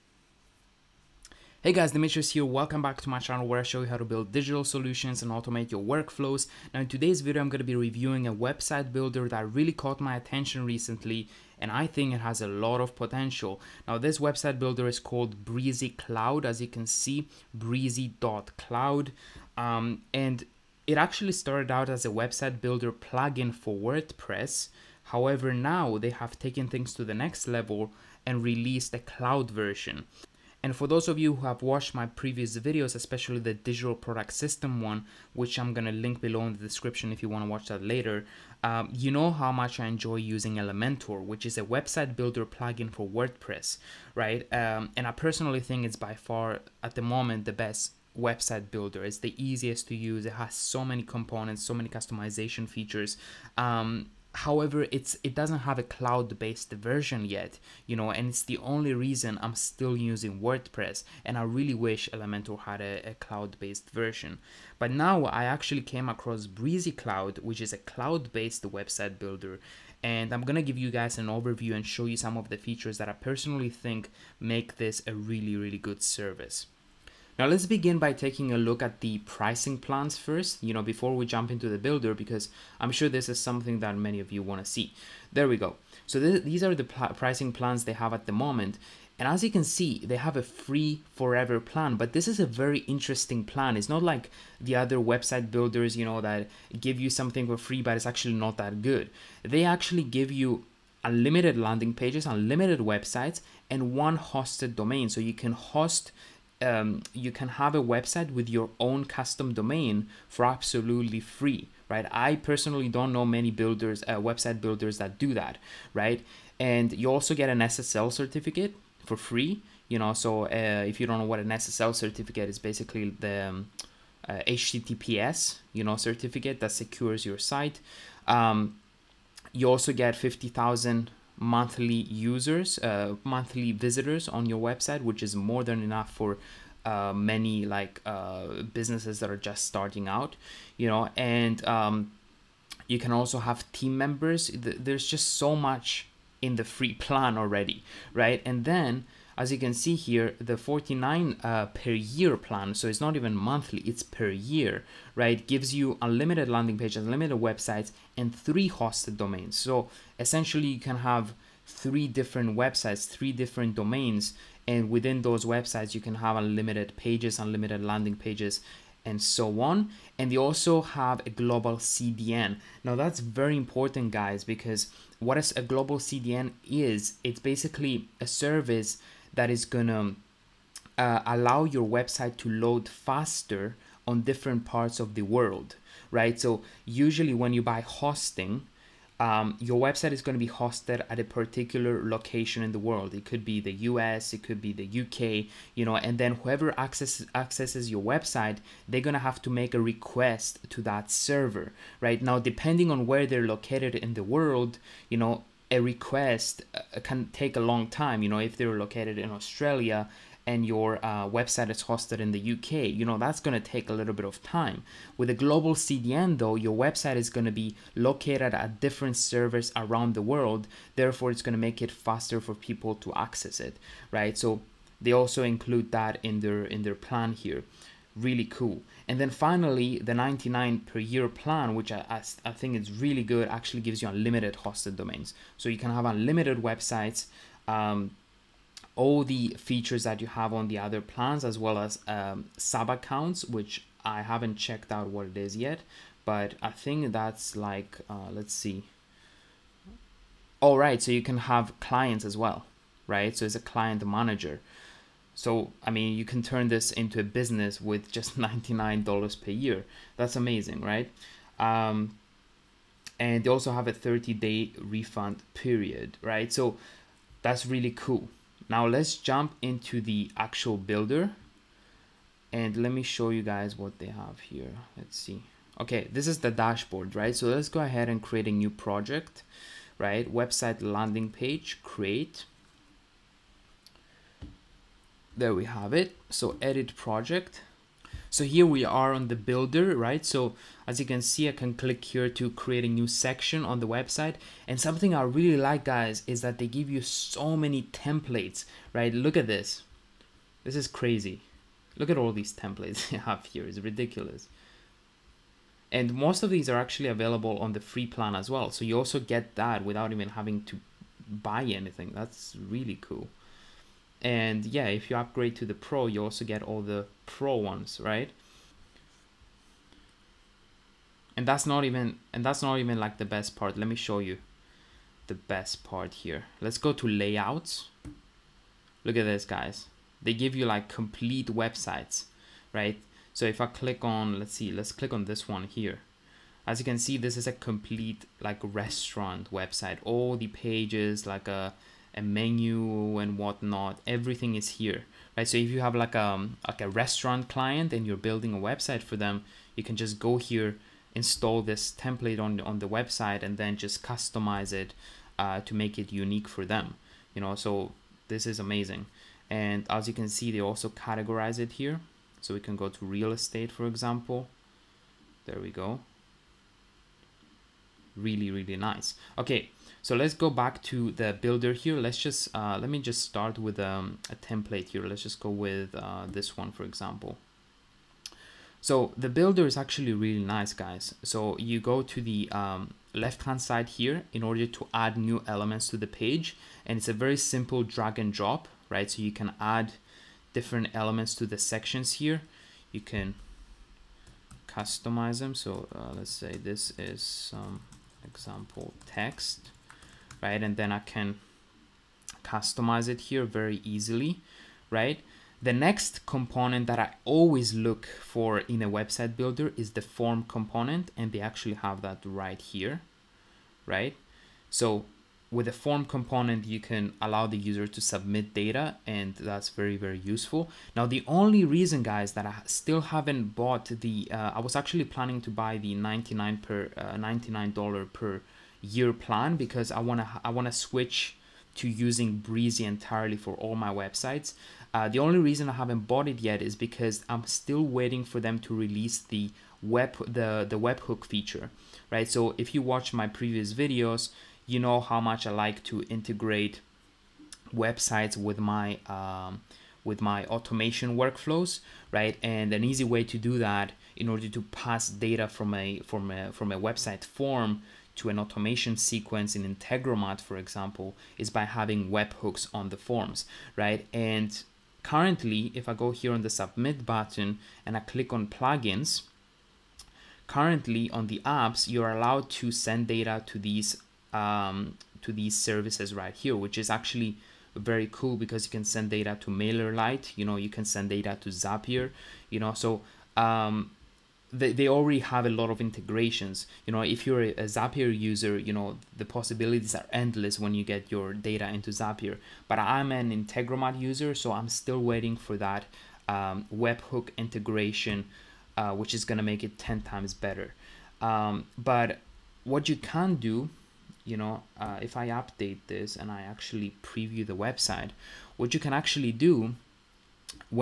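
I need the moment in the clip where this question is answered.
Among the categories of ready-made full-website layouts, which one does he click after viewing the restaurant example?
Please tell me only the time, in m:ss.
6:03.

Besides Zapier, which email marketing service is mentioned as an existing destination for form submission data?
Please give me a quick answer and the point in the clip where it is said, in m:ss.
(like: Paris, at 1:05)
MailerLite, at 7:59.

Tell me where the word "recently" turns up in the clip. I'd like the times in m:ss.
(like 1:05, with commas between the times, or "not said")
0:10.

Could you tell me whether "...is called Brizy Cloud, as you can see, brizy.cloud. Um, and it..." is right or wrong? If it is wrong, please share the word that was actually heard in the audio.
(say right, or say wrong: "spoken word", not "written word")
right.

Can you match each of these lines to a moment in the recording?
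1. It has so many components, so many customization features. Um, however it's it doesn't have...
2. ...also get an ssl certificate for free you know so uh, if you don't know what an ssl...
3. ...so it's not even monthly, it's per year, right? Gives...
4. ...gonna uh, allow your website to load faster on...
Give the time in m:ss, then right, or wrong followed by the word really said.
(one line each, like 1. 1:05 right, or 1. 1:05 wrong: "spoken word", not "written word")
1. 0:50 right
2. 1:57 right
3. 2:32 right
4. 2:59 right.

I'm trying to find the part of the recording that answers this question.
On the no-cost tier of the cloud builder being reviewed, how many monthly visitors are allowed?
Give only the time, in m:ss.
2:10.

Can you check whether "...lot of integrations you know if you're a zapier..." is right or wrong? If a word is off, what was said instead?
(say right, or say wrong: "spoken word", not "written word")
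right.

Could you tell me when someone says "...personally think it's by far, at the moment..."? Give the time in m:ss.
0:45.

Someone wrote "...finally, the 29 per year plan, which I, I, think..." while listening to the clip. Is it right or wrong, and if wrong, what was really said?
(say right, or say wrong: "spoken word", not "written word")
wrong: "99", not "29".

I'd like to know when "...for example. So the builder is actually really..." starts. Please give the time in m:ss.
6:16.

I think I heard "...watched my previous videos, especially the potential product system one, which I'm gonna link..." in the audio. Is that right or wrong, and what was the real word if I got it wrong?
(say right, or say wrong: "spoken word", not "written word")
wrong: "digital", not "potential".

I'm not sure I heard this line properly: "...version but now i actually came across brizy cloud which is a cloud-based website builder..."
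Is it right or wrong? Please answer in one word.
right.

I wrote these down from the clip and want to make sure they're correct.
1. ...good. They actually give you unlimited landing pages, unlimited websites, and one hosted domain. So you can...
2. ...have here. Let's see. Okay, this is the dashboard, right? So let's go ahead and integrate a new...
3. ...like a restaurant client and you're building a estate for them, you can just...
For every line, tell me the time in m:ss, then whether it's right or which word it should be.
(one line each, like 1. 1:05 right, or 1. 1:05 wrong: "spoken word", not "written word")
1. 1:38 right
2. 4:34 wrong: "create", not "integrate"
3. 5:46 wrong: "website", not "estate".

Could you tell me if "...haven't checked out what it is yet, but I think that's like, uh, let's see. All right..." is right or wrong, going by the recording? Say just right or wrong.
right.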